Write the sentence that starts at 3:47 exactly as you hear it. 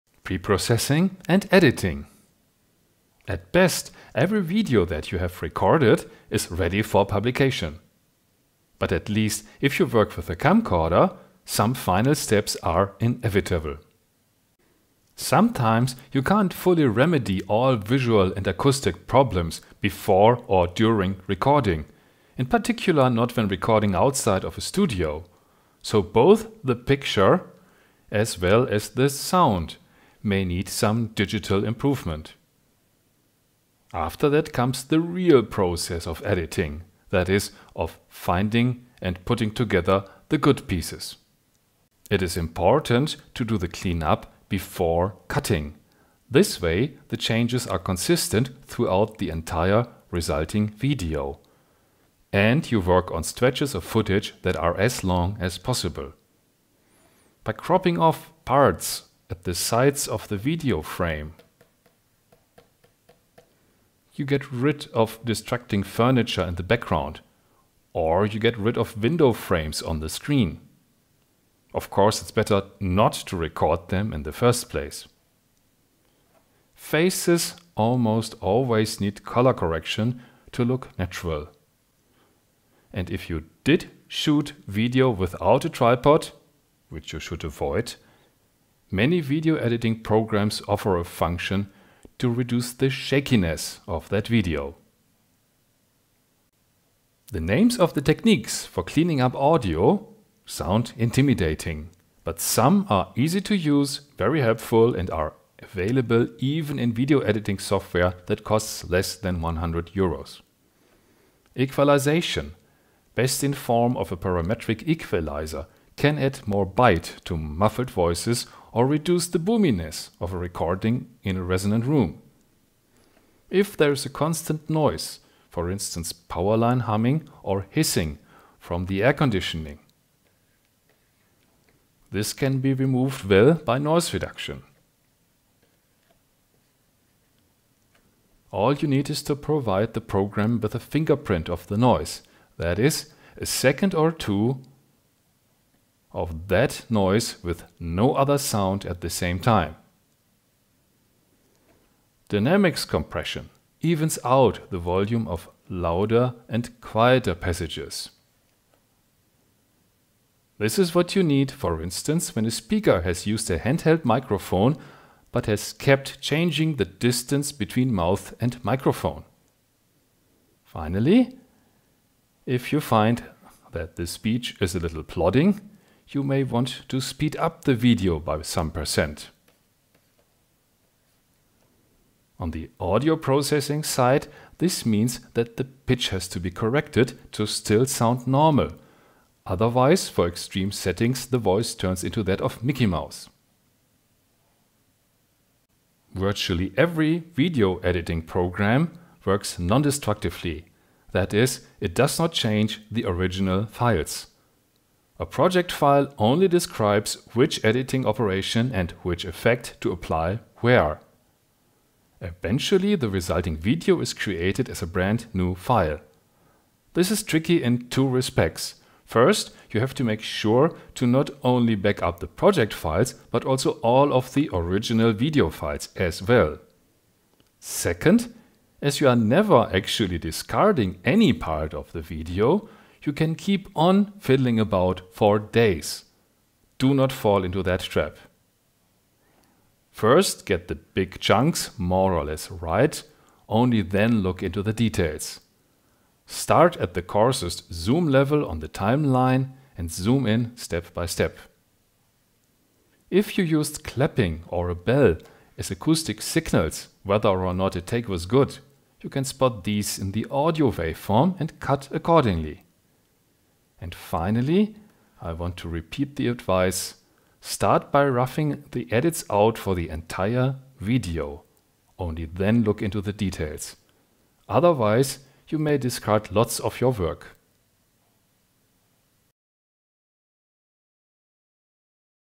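Second, as you are never actually discarding any part of the video, you can keep on fiddling about for days.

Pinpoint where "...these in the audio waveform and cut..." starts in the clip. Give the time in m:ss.
4:19.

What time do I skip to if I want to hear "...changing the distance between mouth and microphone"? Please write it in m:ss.
2:46.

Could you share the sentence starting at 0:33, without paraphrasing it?
After that comes the real process of editing, that is, of finding and putting together the good pieces.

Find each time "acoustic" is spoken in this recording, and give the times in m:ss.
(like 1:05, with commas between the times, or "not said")
0:18, 4:15.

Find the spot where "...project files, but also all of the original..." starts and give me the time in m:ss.
3:42.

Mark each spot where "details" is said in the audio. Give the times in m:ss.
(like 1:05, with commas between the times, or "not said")
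4:04, 4:33.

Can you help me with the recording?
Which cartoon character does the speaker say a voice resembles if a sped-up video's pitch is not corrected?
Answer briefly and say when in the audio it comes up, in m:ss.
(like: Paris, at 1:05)
Mickey Mouse, at 3:12.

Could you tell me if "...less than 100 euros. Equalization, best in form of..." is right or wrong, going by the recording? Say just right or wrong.
right.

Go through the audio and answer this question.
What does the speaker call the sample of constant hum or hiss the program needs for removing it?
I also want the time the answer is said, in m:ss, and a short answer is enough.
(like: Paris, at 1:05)
fingerprint, at 2:20.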